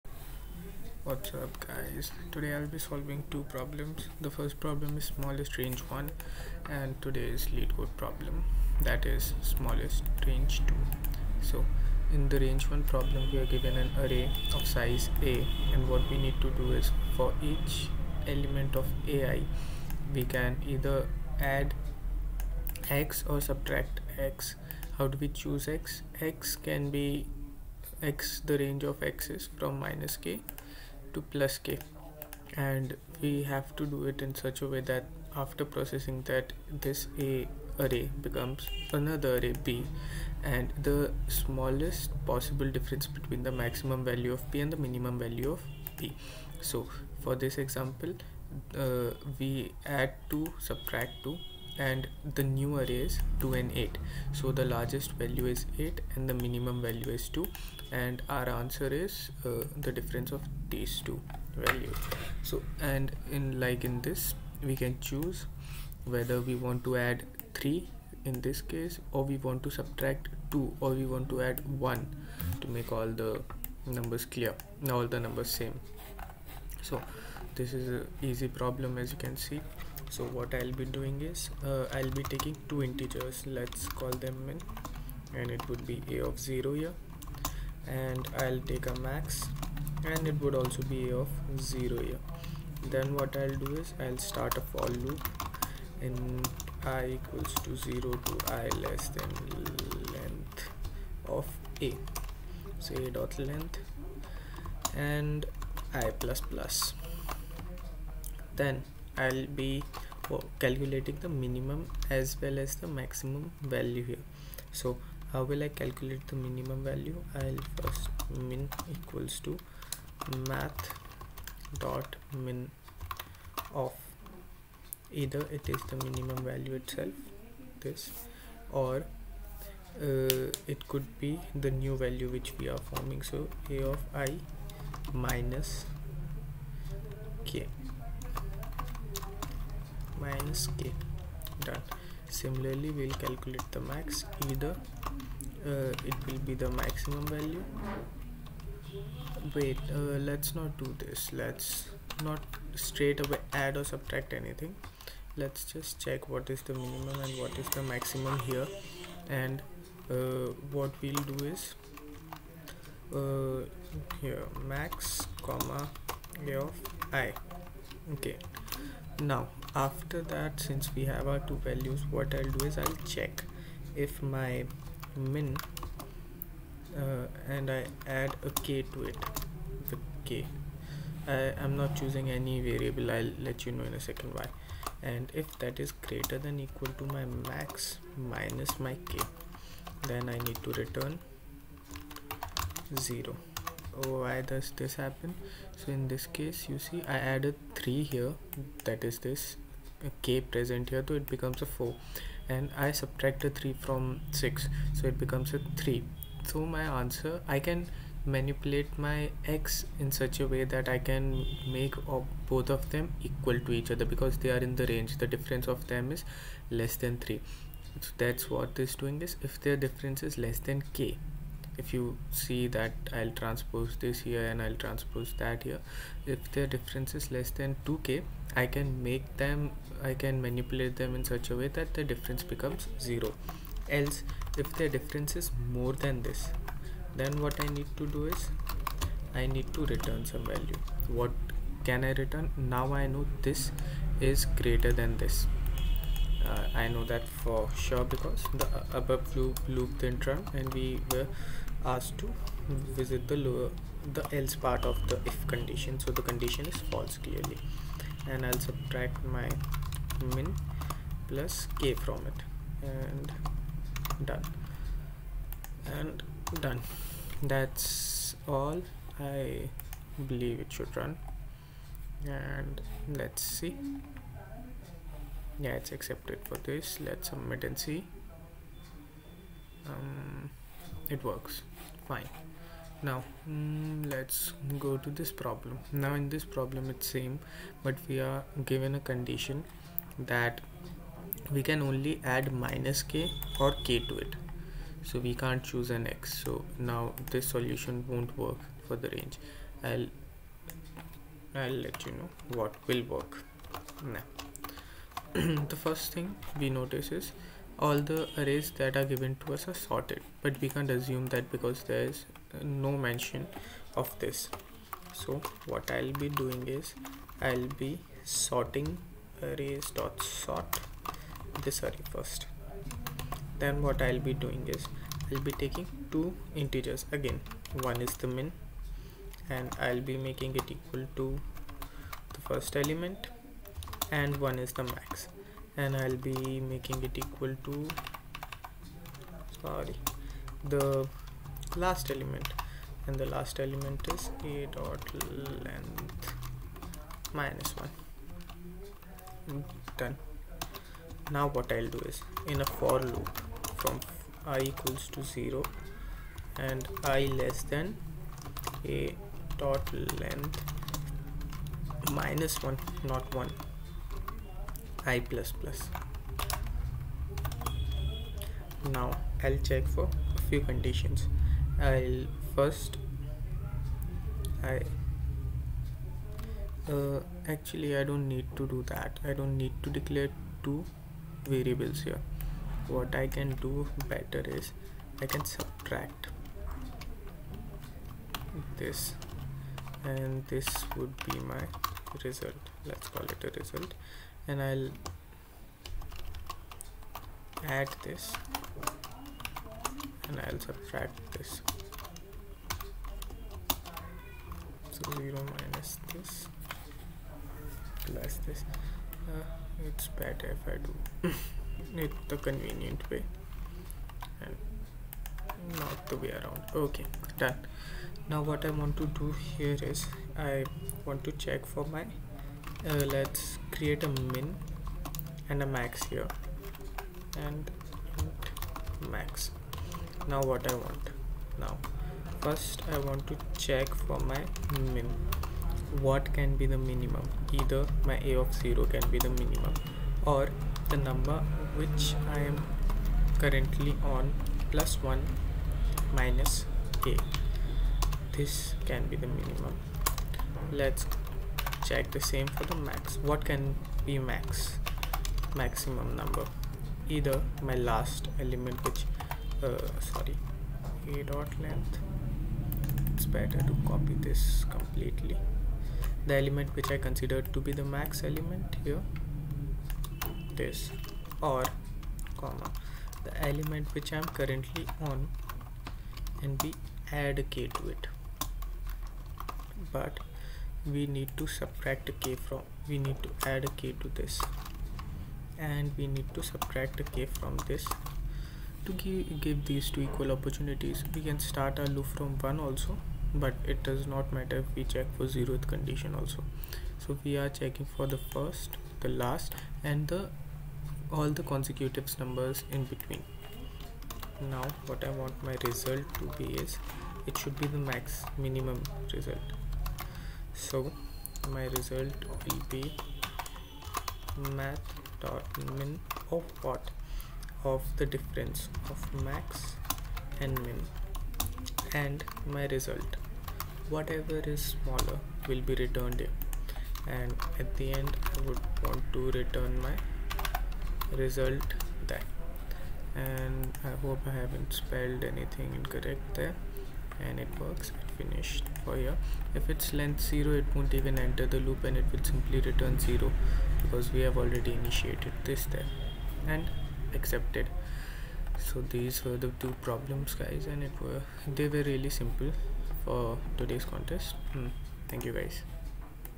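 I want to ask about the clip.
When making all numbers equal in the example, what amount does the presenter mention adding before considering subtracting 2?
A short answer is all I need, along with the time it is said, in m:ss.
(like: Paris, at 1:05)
3, at 1:06.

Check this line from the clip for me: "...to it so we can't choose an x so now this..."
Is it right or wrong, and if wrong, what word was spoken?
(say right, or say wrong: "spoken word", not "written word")
right.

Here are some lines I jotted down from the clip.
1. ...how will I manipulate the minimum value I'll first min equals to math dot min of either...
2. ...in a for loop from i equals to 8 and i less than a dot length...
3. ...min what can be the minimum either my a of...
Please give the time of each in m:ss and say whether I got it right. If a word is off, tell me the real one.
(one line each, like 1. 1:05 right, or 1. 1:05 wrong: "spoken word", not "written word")
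1. 1:55 wrong: "calculate", not "manipulate"
2. 5:52 wrong: "0", not "8"
3. 7:14 right.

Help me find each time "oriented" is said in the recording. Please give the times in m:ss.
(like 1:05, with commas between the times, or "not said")
not said.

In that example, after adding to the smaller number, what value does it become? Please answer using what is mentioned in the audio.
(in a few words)
4.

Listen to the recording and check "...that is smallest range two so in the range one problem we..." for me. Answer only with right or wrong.
right.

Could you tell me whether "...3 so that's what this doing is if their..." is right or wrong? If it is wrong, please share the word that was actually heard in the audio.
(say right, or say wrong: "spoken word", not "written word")
right.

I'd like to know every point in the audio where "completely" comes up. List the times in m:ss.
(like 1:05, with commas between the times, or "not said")
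7:44.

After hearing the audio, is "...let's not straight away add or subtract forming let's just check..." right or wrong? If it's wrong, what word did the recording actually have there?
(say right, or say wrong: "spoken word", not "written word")
wrong: "anything", not "forming".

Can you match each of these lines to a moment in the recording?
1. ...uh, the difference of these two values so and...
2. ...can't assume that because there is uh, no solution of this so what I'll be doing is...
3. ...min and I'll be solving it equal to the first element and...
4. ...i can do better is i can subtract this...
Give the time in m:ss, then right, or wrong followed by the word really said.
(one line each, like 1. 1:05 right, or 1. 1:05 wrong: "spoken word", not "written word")
1. 0:59 right
2. 5:10 wrong: "mention", not "solution"
3. 5:28 wrong: "making", not "solving"
4. 6:23 right.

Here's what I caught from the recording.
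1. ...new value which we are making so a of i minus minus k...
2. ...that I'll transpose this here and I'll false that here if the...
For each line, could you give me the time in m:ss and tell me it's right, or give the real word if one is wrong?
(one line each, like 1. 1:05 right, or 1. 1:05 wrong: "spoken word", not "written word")
1. 2:11 wrong: "forming", not "making"
2. 3:42 wrong: "transpose", not "false".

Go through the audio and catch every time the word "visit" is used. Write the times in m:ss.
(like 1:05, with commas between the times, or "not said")
4:12.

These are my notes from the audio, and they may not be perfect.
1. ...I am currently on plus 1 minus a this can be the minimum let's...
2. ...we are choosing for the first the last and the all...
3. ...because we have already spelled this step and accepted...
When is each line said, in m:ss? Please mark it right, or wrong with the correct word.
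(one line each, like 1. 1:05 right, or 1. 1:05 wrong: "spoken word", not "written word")
1. 7:22 right
2. 8:17 wrong: "checking", not "choosing"
3. 9:03 wrong: "initiated", not "spelled".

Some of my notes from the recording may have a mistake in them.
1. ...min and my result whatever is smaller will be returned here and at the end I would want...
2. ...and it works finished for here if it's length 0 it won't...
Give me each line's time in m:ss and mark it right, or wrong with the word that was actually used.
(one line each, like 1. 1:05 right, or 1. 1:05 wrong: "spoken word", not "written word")
1. 8:40 right
2. 8:57 right.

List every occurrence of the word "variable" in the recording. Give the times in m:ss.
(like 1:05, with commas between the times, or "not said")
3:02, 6:21.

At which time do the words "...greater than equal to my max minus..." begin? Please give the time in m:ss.
3:05.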